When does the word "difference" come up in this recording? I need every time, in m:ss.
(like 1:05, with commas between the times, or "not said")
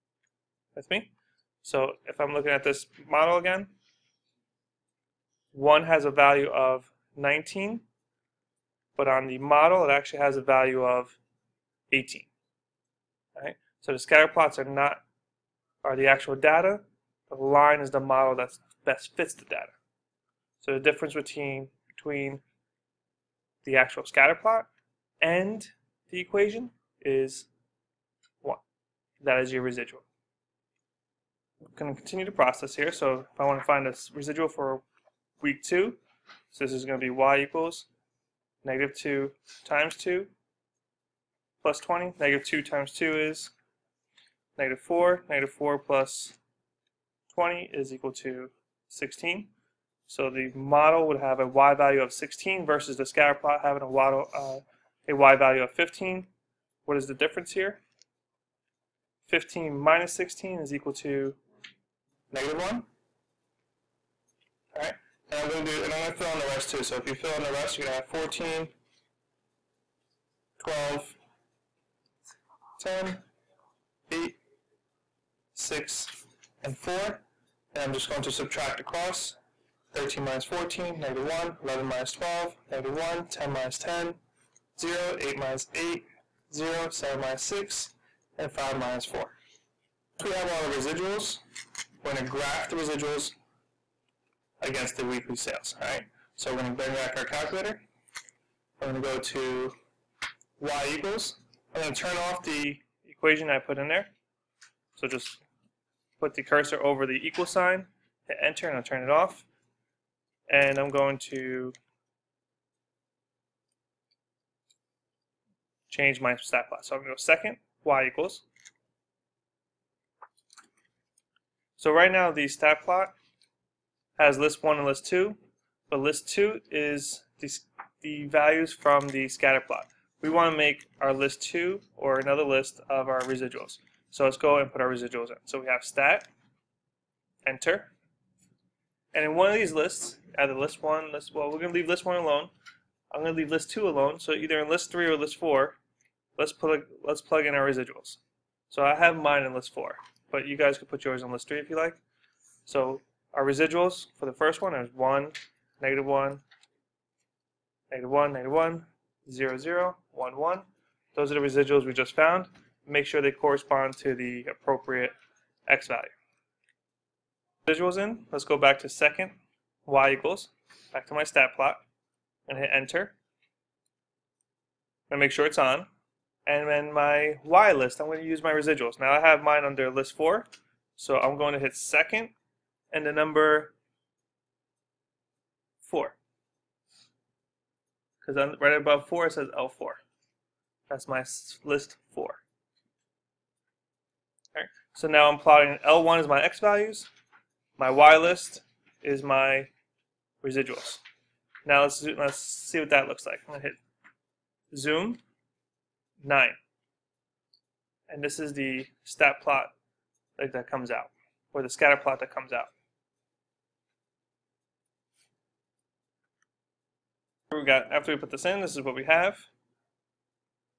0:20, 0:57.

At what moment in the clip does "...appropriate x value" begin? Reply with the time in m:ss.
2:44.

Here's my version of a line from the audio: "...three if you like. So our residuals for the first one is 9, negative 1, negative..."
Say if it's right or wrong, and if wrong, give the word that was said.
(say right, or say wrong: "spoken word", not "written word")
wrong: "1", not "9".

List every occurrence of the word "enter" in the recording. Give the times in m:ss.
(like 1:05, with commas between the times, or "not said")
1:48, 2:17, 2:52.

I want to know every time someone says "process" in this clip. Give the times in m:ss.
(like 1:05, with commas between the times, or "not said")
0:32.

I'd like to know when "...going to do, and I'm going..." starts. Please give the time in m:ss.
1:05.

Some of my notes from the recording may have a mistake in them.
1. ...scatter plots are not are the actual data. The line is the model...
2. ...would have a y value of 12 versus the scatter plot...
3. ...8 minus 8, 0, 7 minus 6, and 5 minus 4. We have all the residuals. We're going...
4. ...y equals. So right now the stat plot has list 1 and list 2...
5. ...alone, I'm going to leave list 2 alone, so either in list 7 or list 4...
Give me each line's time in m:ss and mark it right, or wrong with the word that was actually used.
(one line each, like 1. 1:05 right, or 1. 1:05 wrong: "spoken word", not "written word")
1. 0:13 right
2. 0:51 wrong: "16", not "12"
3. 1:25 right
4. 1:57 right
5. 2:22 wrong: "3", not "7".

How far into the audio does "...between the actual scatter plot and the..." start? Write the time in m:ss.
0:21.